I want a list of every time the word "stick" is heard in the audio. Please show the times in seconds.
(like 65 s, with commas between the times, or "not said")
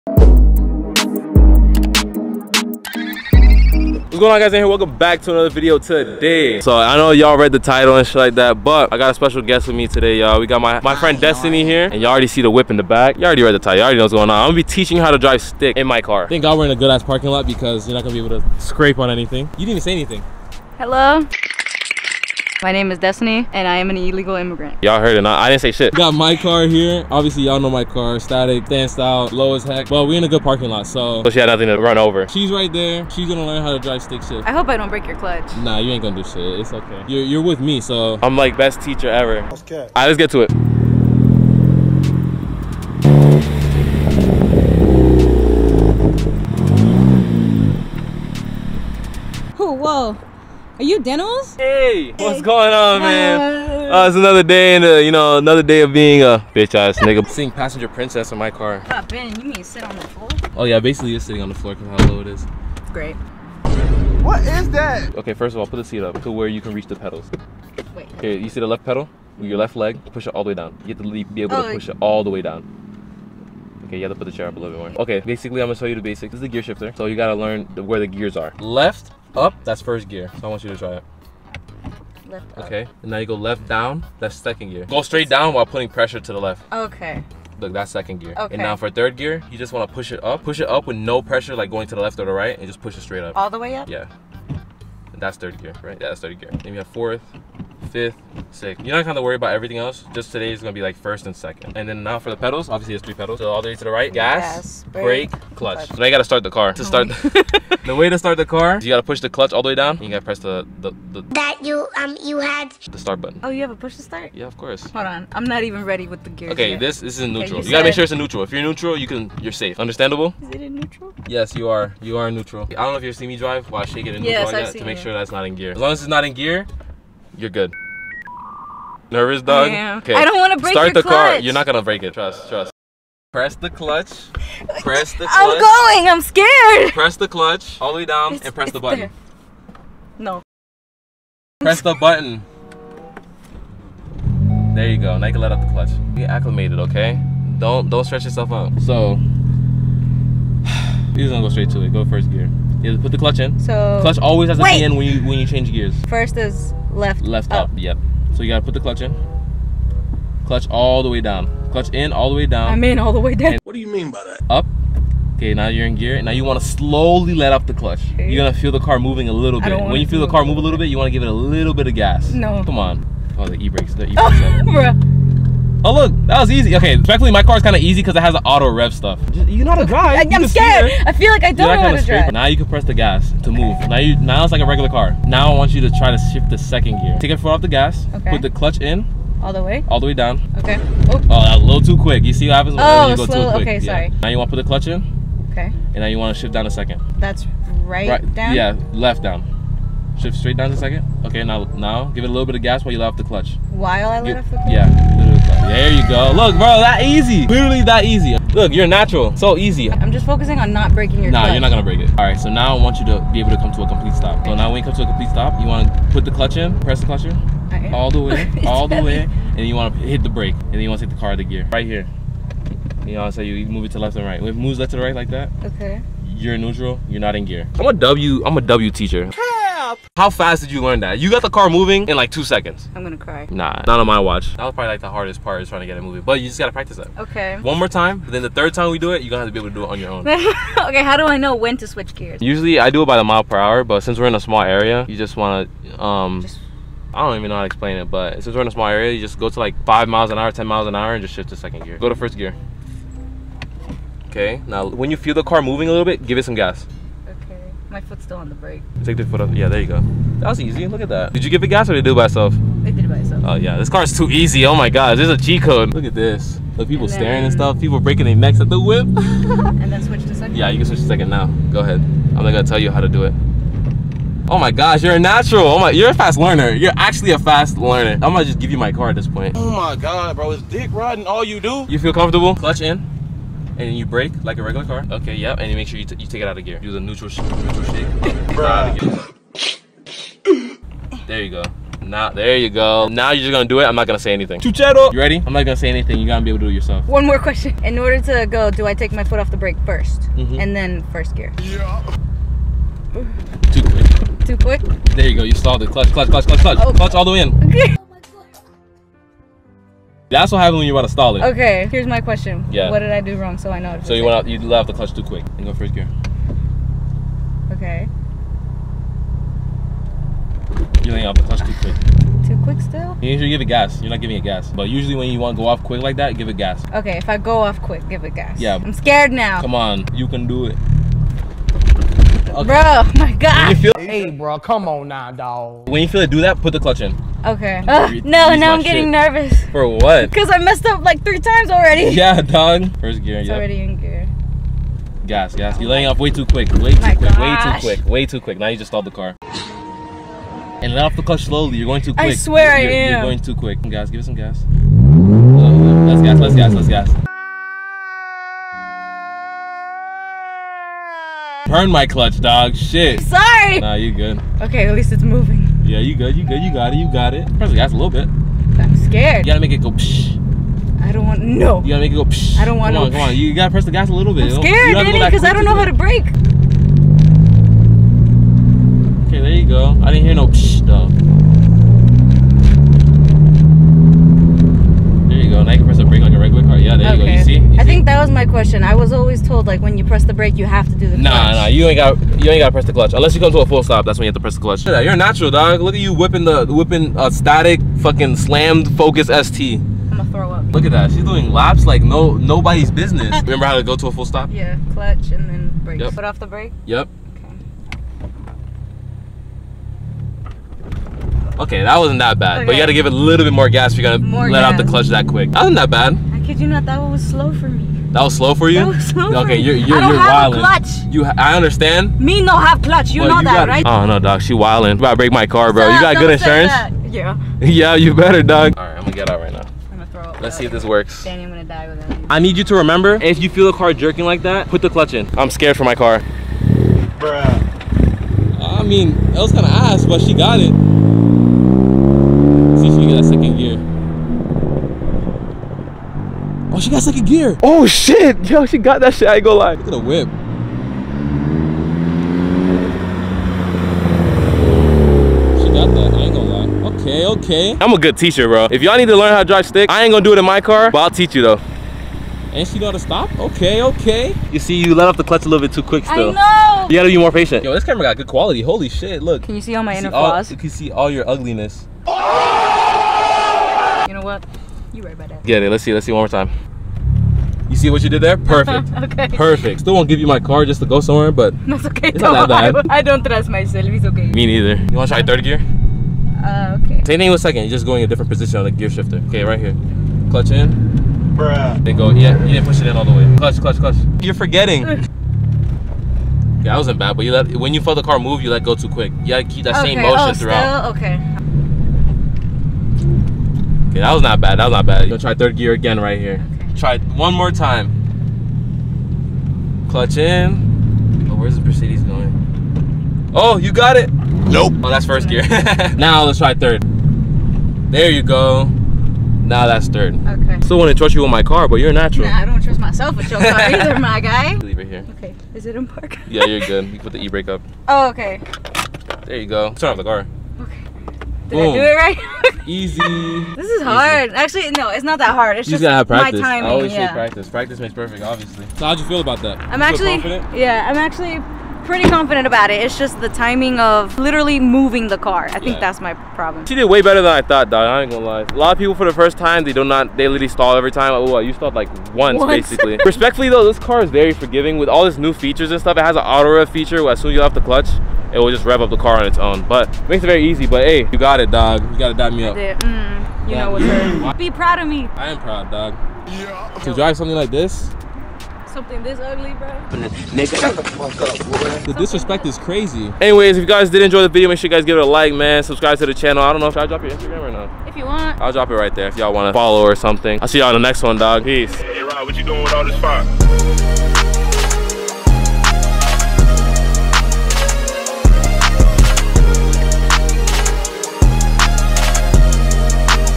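15 s, 34 s, 459 s.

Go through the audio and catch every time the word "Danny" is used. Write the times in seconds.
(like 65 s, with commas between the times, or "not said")
374 s, 431 s.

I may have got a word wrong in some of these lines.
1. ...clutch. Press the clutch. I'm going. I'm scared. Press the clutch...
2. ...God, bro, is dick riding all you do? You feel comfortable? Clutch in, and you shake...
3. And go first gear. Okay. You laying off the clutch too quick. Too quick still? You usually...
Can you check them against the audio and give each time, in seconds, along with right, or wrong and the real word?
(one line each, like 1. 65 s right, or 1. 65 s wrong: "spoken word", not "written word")
1. 133 s right
2. 279 s wrong: "brake", not "shake"
3. 315 s right.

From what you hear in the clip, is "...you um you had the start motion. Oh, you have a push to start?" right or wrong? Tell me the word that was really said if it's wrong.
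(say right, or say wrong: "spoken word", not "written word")
wrong: "button", not "motion".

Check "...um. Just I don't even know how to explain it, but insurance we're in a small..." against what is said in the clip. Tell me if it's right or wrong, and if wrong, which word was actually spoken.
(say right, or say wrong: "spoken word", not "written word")
wrong: "since", not "insurance".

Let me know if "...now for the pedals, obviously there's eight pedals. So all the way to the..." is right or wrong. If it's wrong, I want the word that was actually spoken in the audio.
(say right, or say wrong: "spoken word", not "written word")
wrong: "three", not "eight".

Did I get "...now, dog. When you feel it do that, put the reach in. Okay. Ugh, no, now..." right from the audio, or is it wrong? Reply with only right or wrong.
wrong.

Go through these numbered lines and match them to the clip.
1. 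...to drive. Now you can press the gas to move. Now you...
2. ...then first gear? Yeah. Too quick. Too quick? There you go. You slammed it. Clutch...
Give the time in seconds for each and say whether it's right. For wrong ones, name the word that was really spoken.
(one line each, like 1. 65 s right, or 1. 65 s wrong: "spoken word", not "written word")
1. 181 s right
2. 300 s wrong: "stalled", not "slammed".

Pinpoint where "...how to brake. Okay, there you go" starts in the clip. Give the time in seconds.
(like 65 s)
375 s.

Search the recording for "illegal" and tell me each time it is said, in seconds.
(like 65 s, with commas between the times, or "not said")
23 s.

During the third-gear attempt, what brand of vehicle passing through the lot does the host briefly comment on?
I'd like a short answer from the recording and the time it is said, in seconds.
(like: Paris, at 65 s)
Mercedes, at 511 s.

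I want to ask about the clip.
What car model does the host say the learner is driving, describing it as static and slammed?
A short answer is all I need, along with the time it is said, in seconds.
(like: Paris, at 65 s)
Focus ST, at 398 s.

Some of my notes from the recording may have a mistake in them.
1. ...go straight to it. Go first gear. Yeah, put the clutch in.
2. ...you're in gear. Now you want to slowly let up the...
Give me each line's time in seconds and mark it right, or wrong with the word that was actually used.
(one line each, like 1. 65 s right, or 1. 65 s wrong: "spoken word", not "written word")
1. 151 s right
2. 165 s right.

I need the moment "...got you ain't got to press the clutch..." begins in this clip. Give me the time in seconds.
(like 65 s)
391 s.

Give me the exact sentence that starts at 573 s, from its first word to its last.
Anyways, if you guys did enjoy the video, make sure you guys give it a like, man.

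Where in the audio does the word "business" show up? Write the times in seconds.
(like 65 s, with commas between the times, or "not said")
402 s.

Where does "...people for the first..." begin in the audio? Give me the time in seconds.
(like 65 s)
548 s.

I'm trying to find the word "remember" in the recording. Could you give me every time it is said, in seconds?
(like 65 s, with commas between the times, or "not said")
403 s, 432 s.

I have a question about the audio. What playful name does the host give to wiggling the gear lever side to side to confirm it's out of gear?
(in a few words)
Neutral shake.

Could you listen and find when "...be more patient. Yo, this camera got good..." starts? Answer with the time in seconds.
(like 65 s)
467 s.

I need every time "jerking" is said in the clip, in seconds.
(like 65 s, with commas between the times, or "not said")
433 s.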